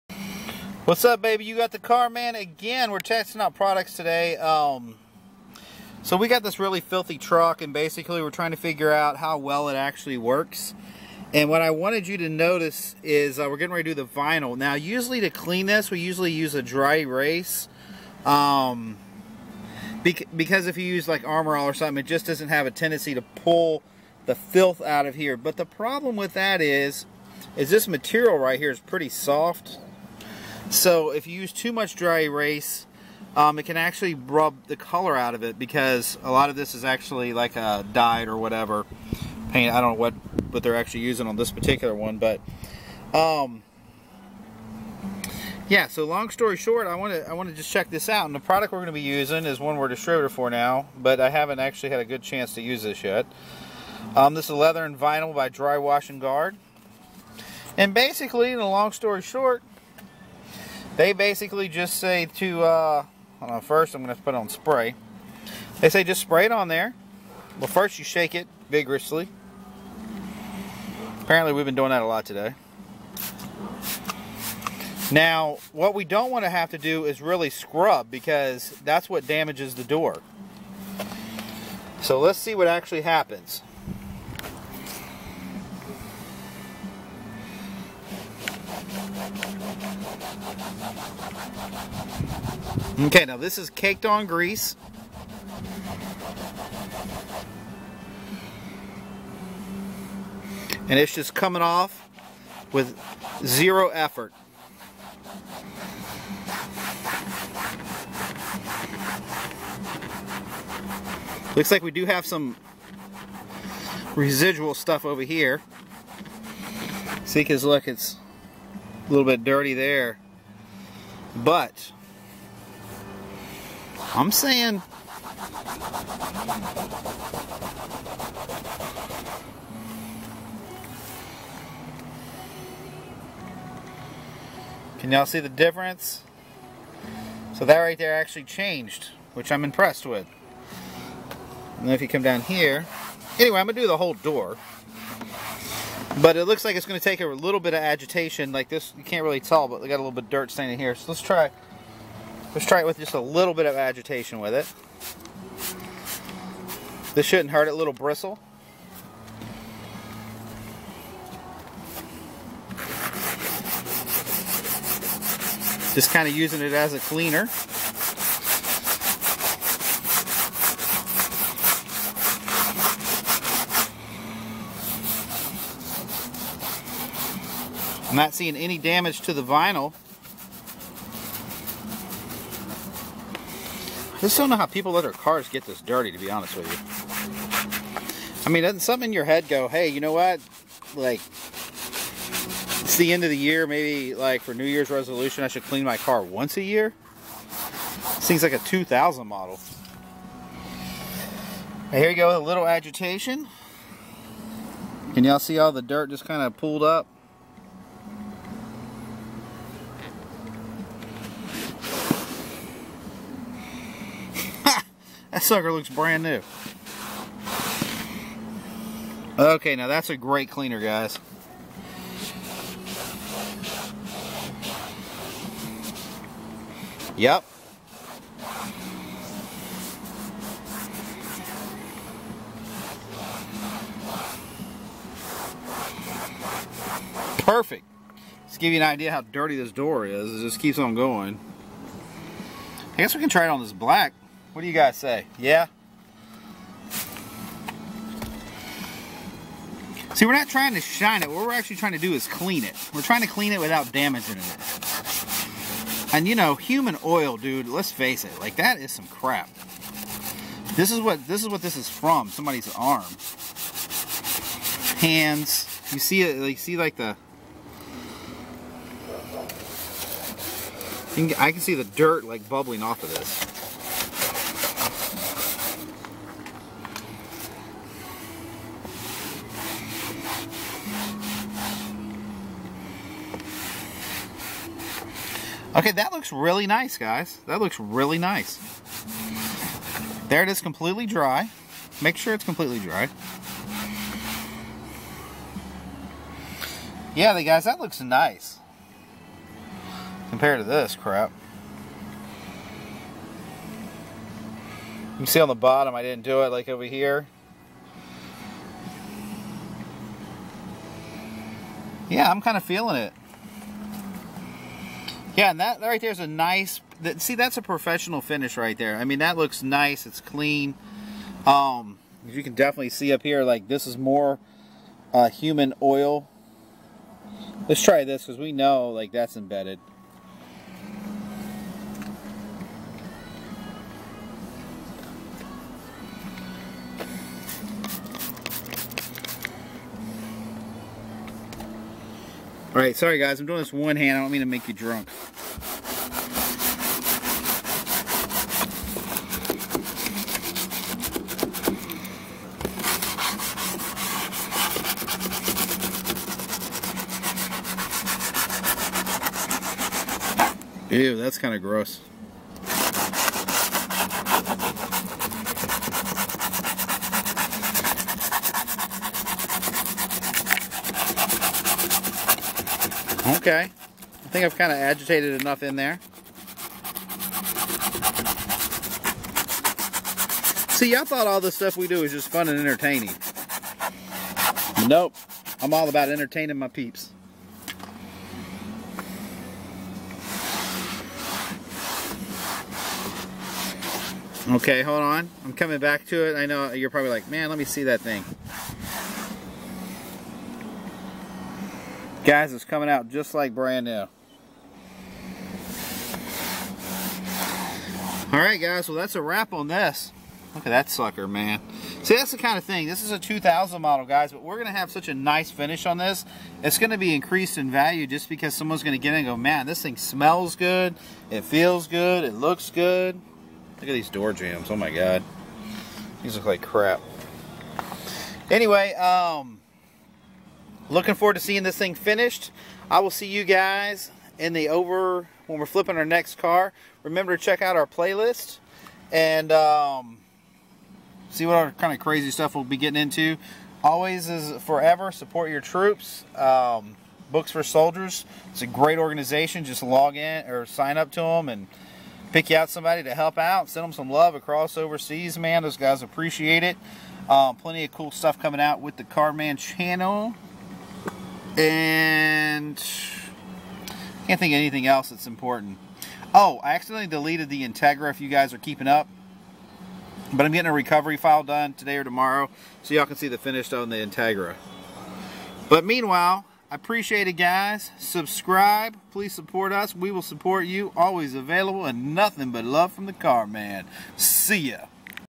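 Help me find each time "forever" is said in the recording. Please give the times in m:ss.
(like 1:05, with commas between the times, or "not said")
7:24.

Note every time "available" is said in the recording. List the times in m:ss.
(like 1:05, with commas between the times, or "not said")
8:01.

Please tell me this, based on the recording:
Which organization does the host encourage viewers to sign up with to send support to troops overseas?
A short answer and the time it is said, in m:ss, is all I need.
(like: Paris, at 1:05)
Books for Soldiers, at 7:27.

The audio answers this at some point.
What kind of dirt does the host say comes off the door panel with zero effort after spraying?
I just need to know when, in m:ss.
1:33.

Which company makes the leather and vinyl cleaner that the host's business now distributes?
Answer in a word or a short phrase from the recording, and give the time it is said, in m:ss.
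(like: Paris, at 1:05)
Dri Wash and Guard, at 0:55.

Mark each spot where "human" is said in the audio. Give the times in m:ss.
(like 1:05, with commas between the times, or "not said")
4:16, 5:25.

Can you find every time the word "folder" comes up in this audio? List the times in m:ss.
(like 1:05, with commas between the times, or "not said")
not said.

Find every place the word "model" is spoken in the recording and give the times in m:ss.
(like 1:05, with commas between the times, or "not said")
3:19, 6:53.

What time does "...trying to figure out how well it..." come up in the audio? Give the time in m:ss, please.
0:08.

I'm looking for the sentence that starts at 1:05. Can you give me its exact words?
They say just spray it on there.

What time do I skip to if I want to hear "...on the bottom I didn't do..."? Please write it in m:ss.
5:05.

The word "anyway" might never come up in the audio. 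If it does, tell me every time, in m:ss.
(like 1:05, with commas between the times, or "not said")
2:23, 7:08.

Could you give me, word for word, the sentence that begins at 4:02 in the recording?
I guess we can try it on this black.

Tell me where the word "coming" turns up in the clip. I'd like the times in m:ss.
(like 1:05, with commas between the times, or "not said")
1:41, 6:35, 6:42, 7:38.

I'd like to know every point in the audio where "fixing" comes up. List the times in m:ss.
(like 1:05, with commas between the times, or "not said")
not said.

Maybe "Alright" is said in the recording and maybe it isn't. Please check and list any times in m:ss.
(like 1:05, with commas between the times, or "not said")
5:42, 6:48.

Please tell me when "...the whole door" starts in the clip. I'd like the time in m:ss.
2:23.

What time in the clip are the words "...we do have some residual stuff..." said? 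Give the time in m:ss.
1:51.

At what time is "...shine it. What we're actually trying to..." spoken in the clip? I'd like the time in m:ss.
4:10.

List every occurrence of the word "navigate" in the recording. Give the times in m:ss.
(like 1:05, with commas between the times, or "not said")
not said.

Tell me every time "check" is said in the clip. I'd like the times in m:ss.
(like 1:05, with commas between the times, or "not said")
0:47, 7:17.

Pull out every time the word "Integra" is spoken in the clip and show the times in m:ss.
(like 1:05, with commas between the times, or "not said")
7:47, 7:53.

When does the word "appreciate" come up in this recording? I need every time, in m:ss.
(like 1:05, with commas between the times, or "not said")
7:36, 7:56.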